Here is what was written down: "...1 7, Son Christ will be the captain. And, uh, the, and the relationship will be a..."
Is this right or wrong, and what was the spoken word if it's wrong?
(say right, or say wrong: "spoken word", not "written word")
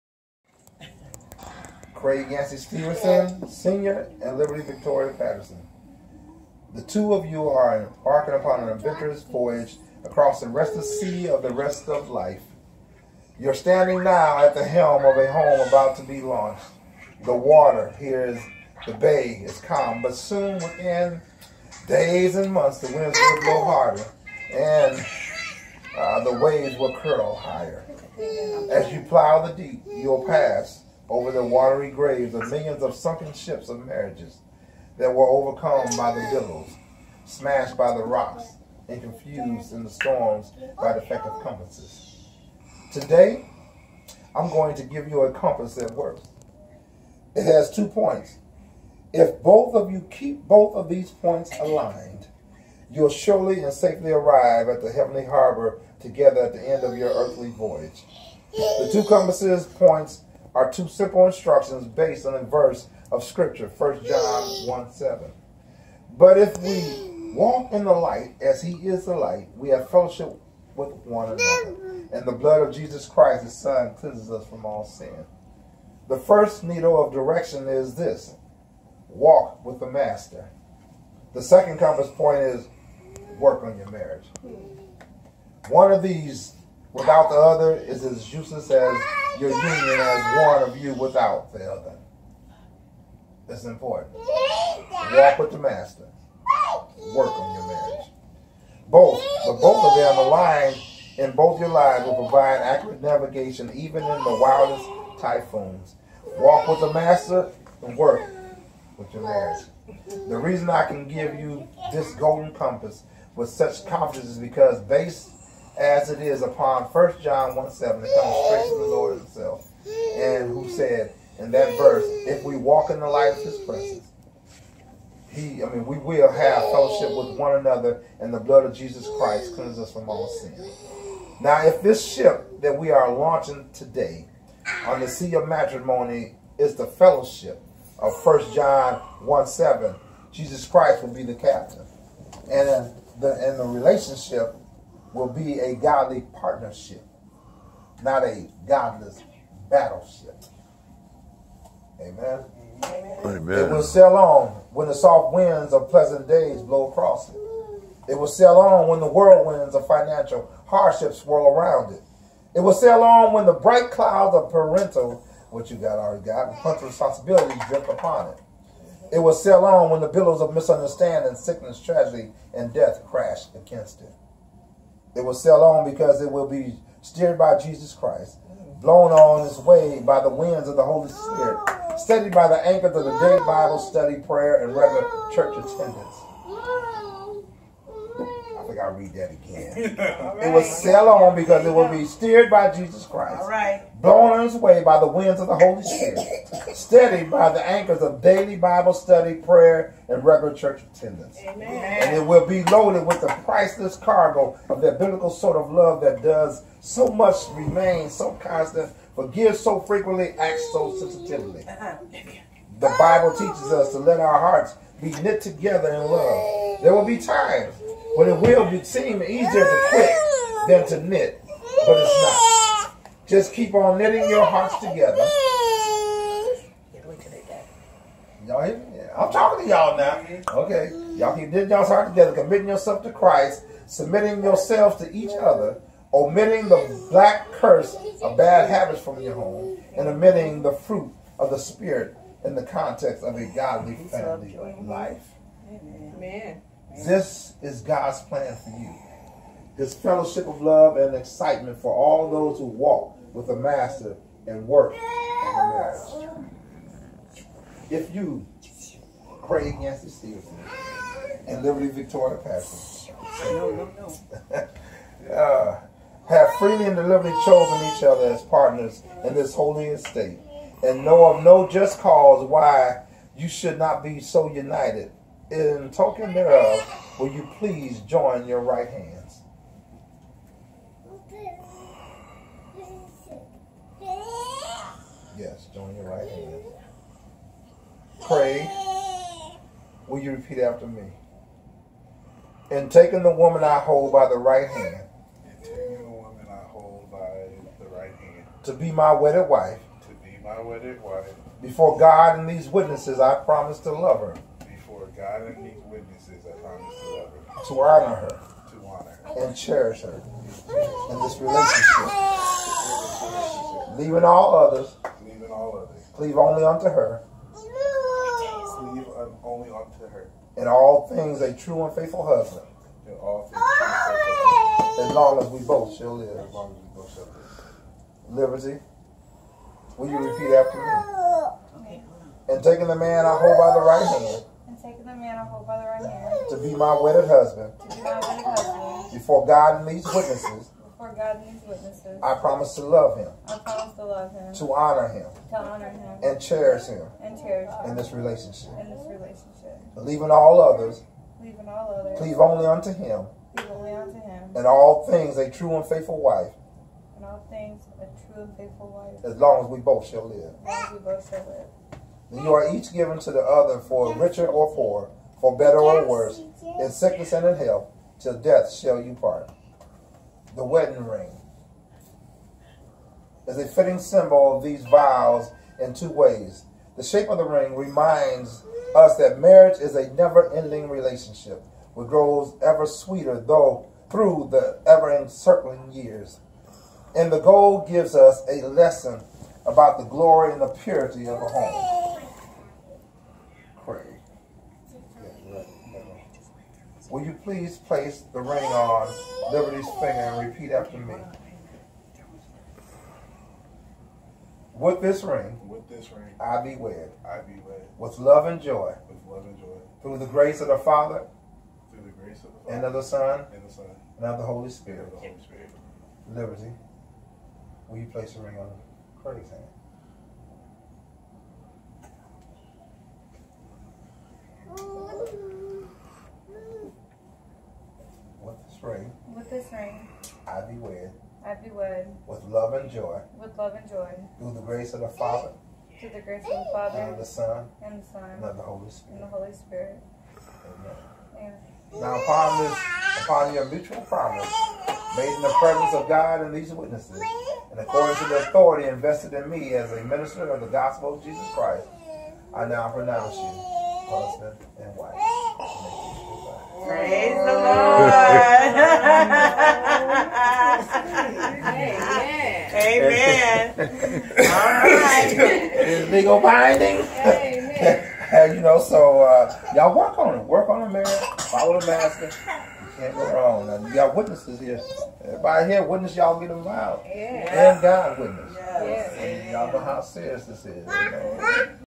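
wrong: "Jesus", not "Son".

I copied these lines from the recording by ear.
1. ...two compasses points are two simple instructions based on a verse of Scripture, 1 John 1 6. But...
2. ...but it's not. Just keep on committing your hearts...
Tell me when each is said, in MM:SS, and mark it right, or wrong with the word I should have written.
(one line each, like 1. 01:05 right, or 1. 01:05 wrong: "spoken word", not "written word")
1. 00:58 wrong: "7", not "6"
2. 03:41 wrong: "knitting", not "committing".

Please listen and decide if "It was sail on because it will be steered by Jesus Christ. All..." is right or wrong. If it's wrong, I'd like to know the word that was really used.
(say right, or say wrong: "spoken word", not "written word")
right.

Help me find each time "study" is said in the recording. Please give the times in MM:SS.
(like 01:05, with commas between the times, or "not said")
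03:03, 03:18.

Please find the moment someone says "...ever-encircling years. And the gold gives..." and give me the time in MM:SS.
06:24.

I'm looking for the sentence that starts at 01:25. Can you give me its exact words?
One of these without the other is as useless as your union as one of you without the other.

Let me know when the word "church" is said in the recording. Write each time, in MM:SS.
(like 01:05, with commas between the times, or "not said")
03:05, 03:20.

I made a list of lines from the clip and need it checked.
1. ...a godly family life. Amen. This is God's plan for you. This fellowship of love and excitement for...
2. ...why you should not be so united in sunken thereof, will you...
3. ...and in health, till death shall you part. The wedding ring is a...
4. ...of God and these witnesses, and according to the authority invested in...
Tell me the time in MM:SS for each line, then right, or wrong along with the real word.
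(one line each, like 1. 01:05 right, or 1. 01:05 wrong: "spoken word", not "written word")
1. 04:03 right
2. 04:32 wrong: "token", not "sunken"
3. 06:07 right
4. 07:25 right.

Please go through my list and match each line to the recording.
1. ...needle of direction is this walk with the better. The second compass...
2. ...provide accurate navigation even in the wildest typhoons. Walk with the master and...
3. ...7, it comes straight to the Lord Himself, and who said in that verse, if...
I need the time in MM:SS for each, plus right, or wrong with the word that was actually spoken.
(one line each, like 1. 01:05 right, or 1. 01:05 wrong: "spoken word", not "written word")
1. 01:16 wrong: "master", not "better"
2. 01:42 right
3. 01:57 right.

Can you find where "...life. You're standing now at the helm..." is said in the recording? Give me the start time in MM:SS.
00:12.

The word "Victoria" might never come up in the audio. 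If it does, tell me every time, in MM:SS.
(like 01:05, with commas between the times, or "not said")
00:04, 04:21.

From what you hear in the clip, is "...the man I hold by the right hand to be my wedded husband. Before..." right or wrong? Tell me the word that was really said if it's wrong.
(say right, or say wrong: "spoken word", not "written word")
right.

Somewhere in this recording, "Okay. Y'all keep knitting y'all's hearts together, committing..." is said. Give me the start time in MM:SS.
03:50.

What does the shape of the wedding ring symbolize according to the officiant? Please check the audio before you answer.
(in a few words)
A never-ending relationship.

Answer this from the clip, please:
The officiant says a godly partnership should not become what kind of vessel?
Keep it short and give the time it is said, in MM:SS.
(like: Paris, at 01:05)
A godless battleship, at 02:28.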